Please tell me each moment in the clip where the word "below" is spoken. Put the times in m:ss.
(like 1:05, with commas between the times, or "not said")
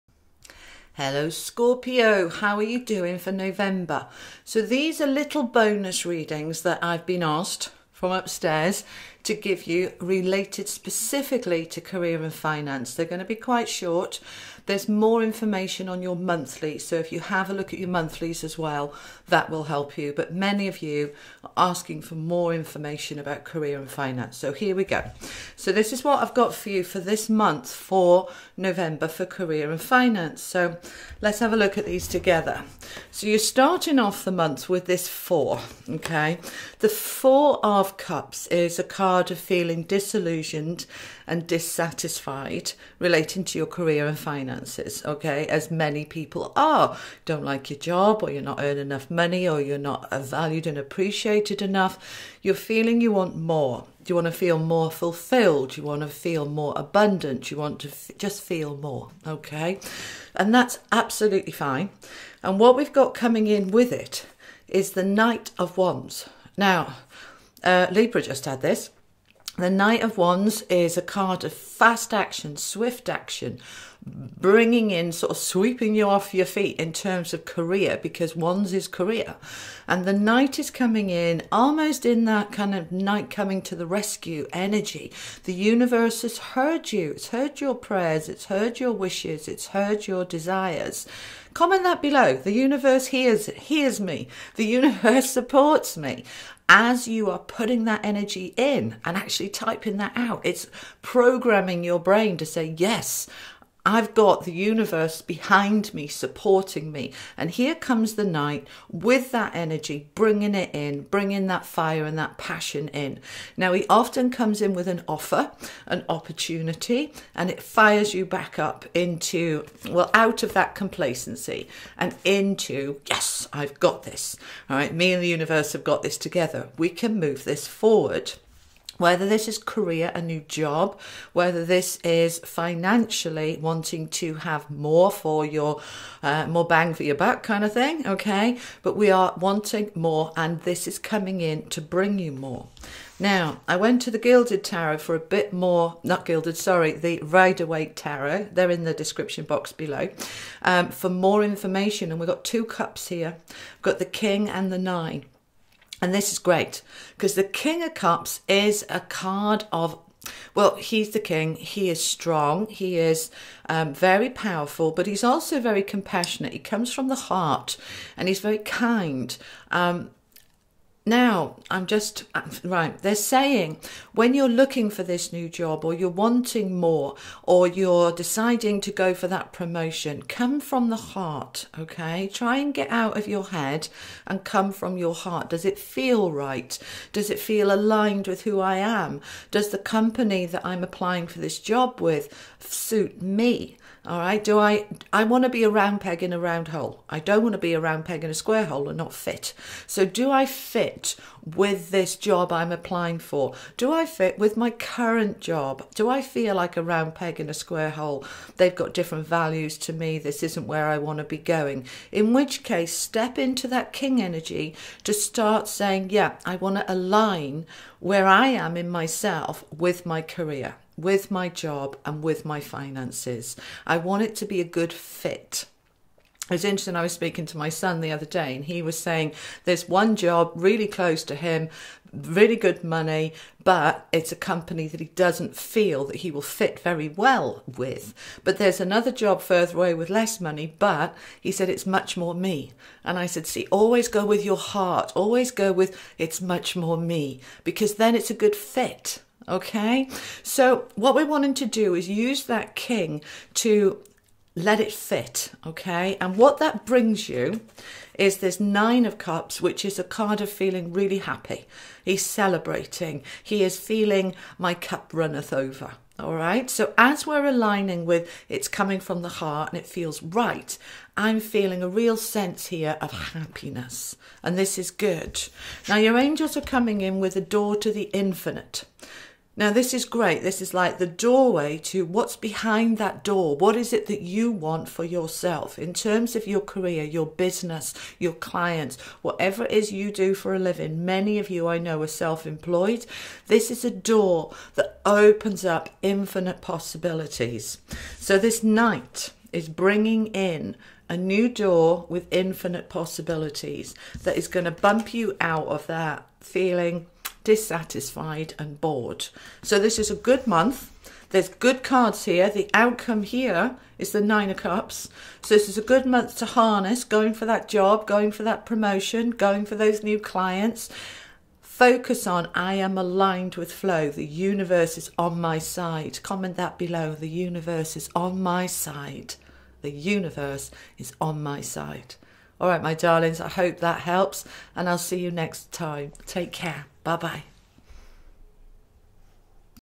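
1:32, 2:29, 5:26.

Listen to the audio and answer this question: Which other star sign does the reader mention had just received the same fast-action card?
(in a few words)
Libra.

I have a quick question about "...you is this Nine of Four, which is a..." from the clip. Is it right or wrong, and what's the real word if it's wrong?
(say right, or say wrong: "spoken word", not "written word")
wrong: "Cups", not "Four".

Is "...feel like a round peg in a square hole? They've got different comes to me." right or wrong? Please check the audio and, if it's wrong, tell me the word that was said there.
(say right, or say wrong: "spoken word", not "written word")
wrong: "values", not "comes".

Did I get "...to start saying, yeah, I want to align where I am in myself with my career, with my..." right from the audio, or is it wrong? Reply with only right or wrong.
right.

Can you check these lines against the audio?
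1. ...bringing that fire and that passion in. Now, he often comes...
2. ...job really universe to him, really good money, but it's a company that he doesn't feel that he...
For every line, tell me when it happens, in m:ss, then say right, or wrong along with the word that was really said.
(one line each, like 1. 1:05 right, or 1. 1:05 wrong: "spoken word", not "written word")
1. 1:51 right
2. 3:50 wrong: "close", not "universe".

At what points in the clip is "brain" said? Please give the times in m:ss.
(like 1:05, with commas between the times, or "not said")
1:41.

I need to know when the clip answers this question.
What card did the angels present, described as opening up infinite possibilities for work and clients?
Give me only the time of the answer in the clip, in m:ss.
4:37.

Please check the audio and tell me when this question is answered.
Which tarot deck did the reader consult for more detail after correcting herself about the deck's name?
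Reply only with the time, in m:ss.
2:26.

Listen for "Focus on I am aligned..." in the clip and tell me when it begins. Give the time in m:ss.
5:21.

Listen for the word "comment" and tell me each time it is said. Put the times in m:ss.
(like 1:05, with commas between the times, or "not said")
1:31, 5:26.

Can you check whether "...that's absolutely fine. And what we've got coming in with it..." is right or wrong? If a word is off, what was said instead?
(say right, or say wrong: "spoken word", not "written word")
right.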